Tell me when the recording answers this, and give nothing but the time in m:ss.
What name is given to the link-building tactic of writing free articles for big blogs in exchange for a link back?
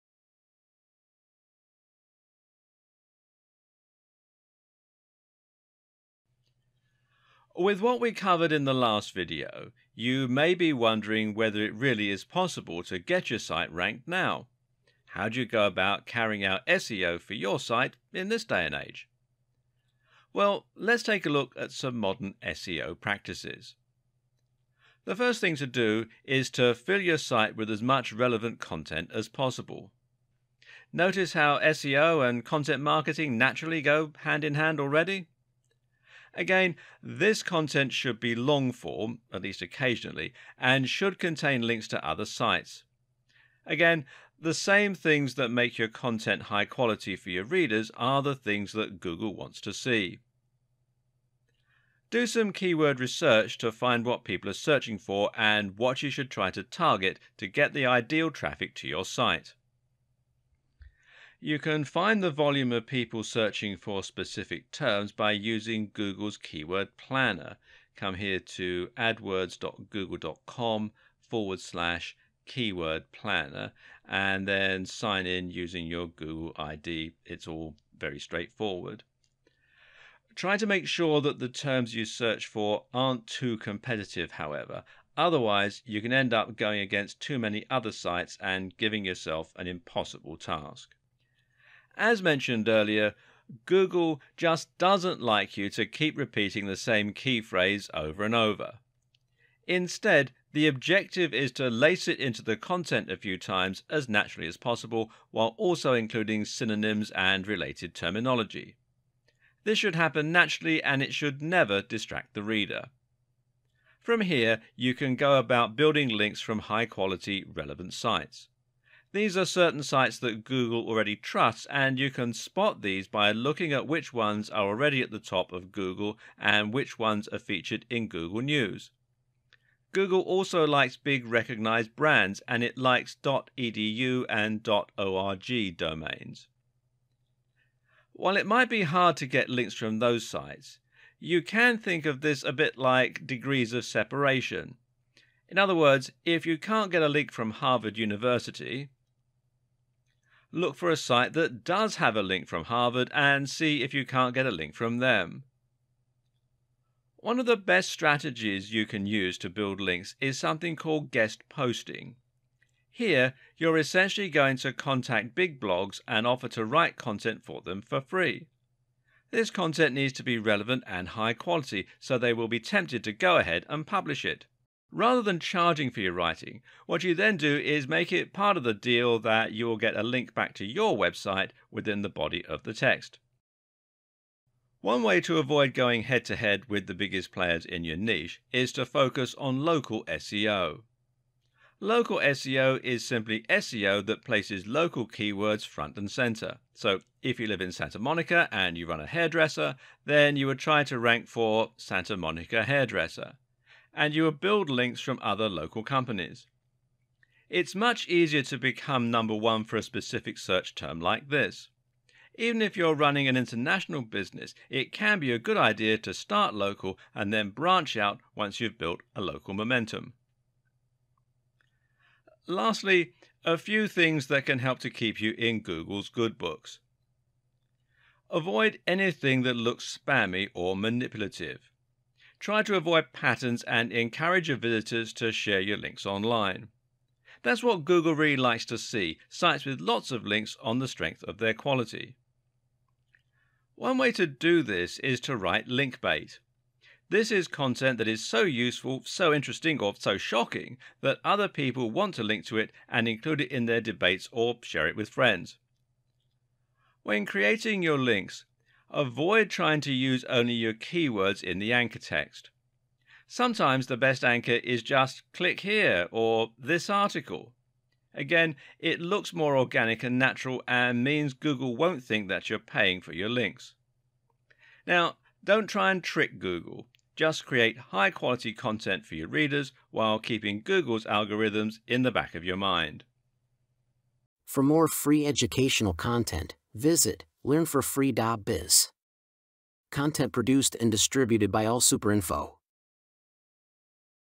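2:41.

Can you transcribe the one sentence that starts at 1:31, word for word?
As mentioned earlier, Google just doesn't like you to keep repeating the same key phrase over and over.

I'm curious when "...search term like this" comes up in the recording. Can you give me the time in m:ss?
3:30.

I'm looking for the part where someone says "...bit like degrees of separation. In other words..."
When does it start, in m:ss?
2:22.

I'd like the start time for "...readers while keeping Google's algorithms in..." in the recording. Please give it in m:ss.
4:39.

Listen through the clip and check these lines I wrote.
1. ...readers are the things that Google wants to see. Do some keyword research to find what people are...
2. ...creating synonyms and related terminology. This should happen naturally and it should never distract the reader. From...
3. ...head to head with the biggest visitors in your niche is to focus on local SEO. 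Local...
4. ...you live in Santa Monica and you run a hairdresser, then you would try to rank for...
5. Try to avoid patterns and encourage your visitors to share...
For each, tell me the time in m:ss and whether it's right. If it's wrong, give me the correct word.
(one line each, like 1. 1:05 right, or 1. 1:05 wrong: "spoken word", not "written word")
1. 0:47 right
2. 1:45 wrong: "including", not "creating"
3. 3:06 wrong: "players", not "visitors"
4. 3:17 right
5. 3:52 right.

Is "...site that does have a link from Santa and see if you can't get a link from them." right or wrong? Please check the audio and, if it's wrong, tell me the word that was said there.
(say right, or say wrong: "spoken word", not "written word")
wrong: "Harvard", not "Santa".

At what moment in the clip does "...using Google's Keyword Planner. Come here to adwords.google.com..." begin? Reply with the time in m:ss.
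1:05.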